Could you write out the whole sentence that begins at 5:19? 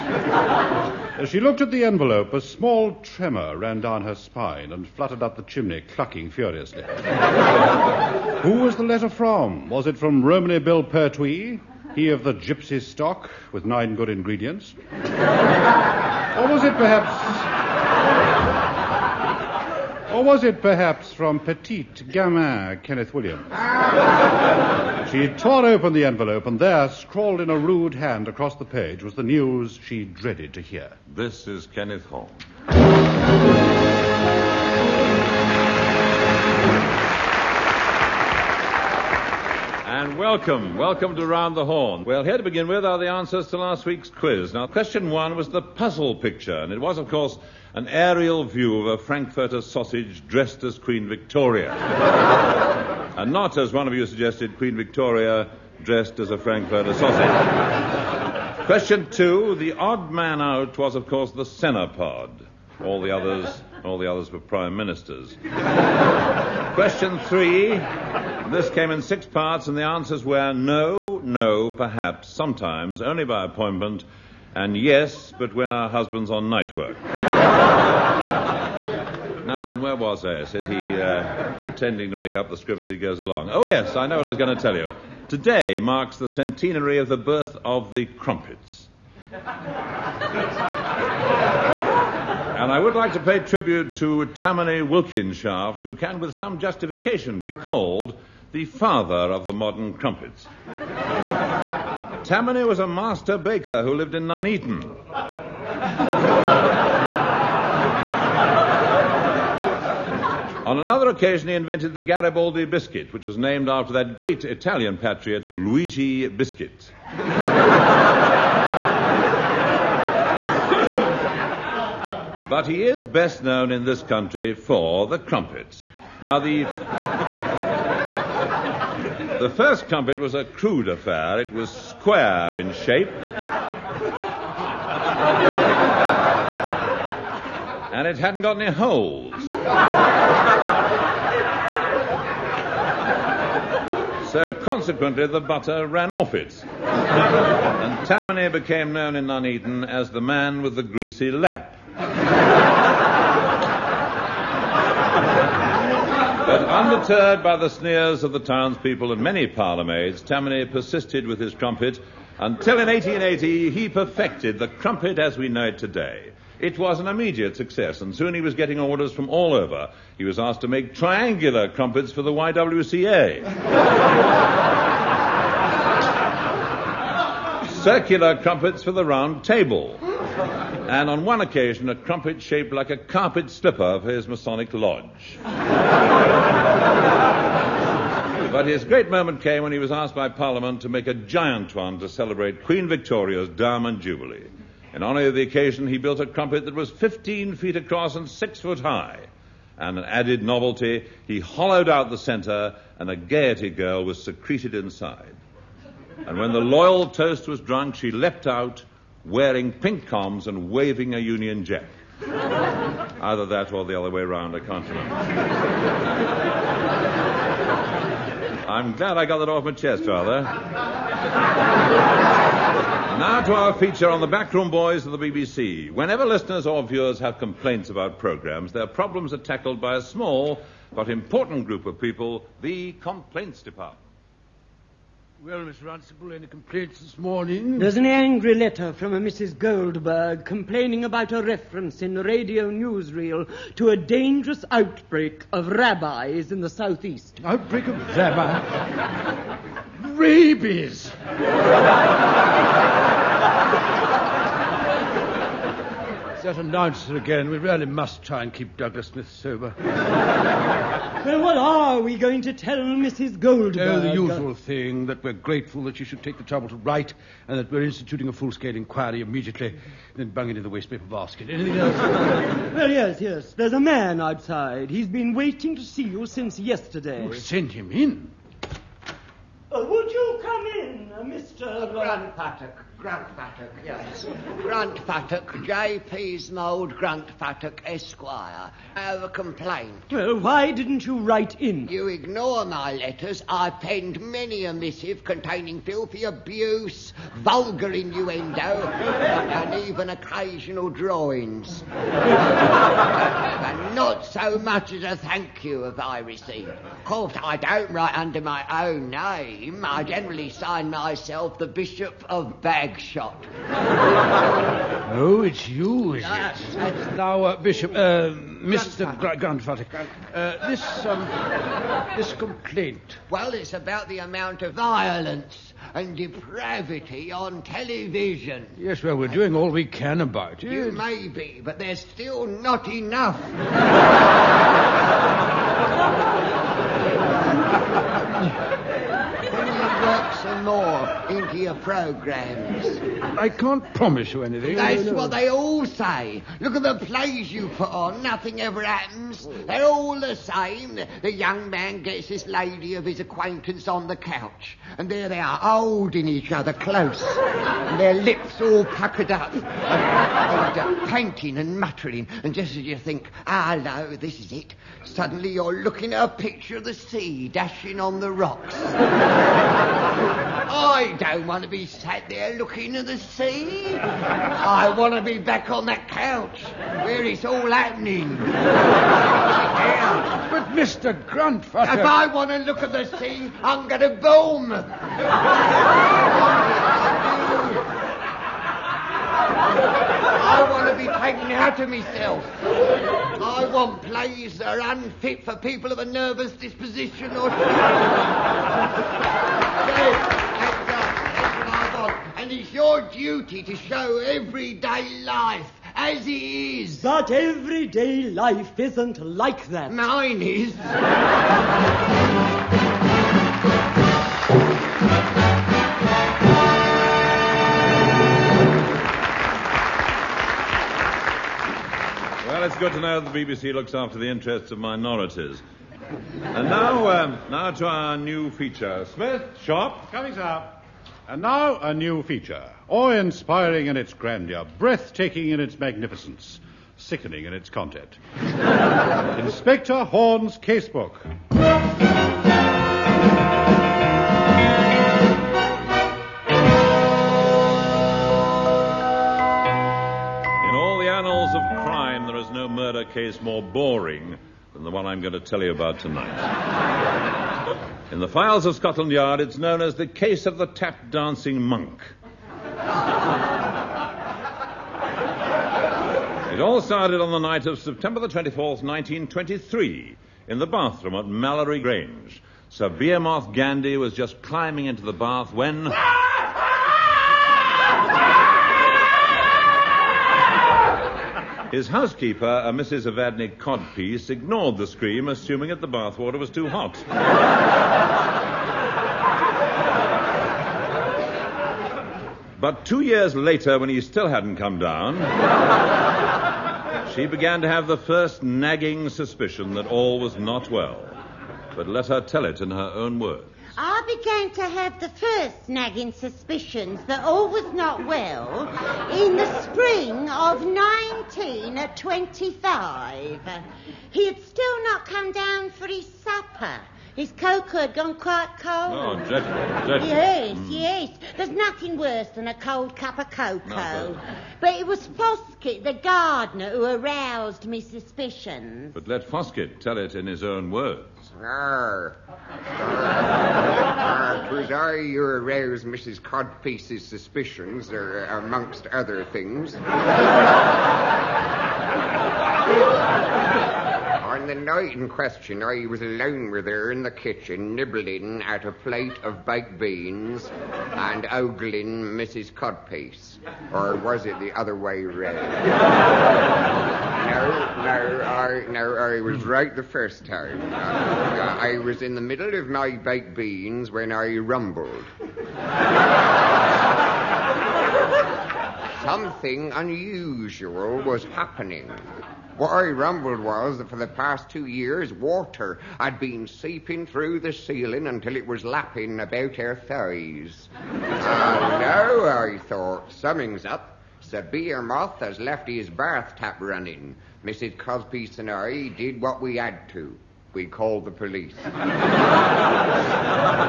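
Grandfather, Grandfather uh, this, um, this complaint.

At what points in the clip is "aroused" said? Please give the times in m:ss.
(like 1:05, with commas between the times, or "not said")
8:46, 8:55.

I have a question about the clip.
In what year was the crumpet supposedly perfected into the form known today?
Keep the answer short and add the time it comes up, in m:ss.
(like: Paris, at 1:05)
1880, at 2:42.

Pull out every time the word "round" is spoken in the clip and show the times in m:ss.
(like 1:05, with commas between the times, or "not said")
0:41, 2:59, 3:34, 9:15.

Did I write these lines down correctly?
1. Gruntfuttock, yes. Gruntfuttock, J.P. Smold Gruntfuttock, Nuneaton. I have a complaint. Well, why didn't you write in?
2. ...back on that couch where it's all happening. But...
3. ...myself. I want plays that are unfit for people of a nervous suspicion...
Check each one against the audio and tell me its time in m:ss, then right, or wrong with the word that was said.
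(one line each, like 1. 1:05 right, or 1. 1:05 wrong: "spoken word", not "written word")
1. 4:43 wrong: "Esquire", not "Nuneaton"
2. 6:15 right
3. 6:31 wrong: "disposition", not "suspicion".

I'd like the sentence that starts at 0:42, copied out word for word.
Well, here to begin with are the answers to last week's quiz.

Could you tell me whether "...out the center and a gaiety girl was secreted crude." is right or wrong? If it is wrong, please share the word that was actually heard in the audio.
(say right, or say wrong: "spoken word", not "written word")
wrong: "inside", not "crude".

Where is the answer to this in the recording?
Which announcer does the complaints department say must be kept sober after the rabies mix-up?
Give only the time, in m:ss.
4:18.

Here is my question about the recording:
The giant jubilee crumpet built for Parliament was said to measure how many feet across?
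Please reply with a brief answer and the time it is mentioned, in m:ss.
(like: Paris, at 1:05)
15 feet, at 3:16.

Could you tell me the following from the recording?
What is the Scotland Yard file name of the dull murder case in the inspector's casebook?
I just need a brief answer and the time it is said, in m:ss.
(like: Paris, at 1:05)
The tap dancing monk, at 7:40.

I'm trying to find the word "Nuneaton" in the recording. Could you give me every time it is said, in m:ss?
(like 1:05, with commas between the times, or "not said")
1:44, 2:29.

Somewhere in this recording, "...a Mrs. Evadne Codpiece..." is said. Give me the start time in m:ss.
8:02.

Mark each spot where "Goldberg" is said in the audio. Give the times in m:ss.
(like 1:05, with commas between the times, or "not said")
3:59, 4:23.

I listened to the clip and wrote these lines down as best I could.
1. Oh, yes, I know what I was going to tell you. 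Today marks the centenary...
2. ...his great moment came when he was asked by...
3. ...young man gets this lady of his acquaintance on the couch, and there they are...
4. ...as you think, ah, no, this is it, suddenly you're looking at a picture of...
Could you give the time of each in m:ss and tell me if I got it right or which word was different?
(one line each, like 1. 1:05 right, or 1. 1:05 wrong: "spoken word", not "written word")
1. 1:23 right
2. 3:08 right
3. 5:51 right
4. 6:02 right.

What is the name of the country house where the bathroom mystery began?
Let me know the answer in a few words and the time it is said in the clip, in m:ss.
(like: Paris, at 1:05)
Mallory Grange, at 7:51.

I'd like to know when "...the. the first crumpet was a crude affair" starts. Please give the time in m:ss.
2:06.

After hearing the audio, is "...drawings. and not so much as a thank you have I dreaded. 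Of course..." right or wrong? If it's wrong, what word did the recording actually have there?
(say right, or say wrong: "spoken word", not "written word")
wrong: "received", not "dreaded".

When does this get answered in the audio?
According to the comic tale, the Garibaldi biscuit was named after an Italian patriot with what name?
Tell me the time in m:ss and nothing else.
1:55.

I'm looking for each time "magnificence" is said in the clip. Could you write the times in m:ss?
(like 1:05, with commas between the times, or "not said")
7:15.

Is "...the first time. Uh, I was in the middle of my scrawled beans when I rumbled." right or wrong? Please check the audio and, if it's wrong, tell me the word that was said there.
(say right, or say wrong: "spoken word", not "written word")
wrong: "baked", not "scrawled".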